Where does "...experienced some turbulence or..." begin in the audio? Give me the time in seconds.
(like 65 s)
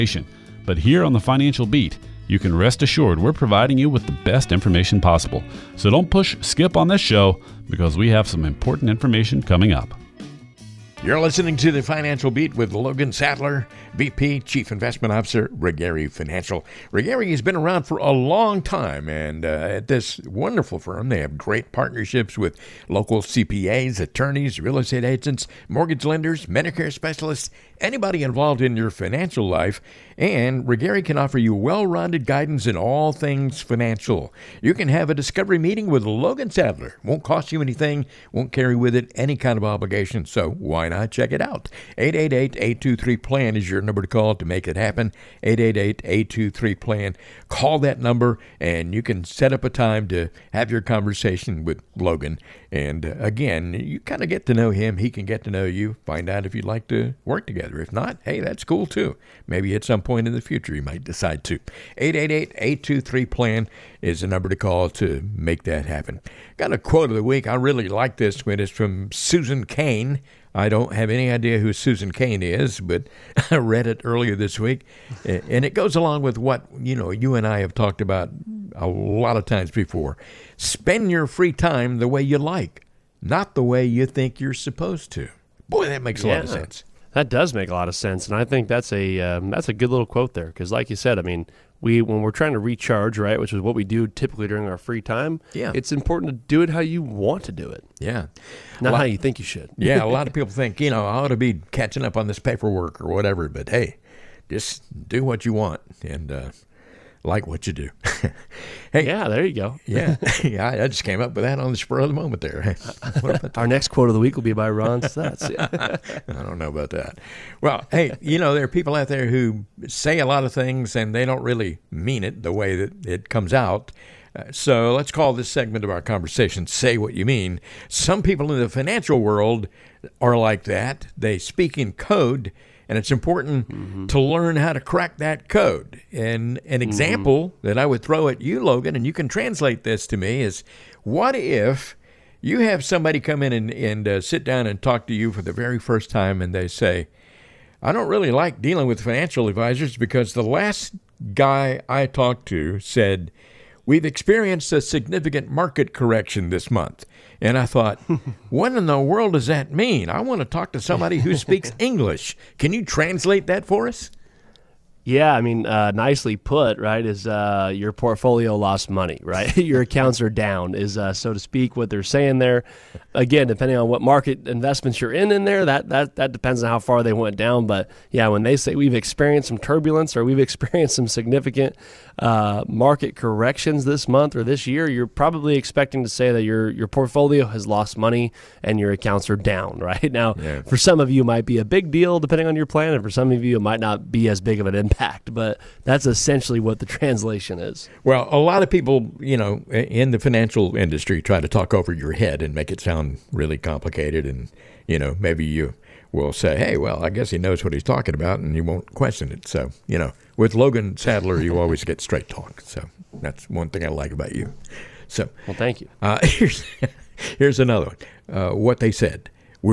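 178 s.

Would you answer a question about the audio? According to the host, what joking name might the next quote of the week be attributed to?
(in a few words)
Ron Stutz.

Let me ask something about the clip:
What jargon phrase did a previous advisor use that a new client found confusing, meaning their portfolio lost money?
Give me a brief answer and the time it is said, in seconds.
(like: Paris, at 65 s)
significant market correction, at 154 s.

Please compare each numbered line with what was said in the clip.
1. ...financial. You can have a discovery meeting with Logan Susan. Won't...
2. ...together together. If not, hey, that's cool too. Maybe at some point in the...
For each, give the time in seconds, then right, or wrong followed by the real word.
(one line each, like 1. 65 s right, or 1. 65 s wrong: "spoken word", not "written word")
1. 33 s wrong: "Sadler", not "Susan"
2. 57 s right.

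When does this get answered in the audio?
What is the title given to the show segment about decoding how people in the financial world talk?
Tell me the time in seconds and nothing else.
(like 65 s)
126 s.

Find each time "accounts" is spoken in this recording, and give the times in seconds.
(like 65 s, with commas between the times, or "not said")
169 s, 188 s.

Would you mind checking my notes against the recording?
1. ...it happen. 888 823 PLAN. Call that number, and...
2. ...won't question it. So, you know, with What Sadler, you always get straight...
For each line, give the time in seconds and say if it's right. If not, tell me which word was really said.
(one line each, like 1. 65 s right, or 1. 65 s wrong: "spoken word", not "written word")
1. 44 s right
2. 208 s wrong: "Logan", not "What".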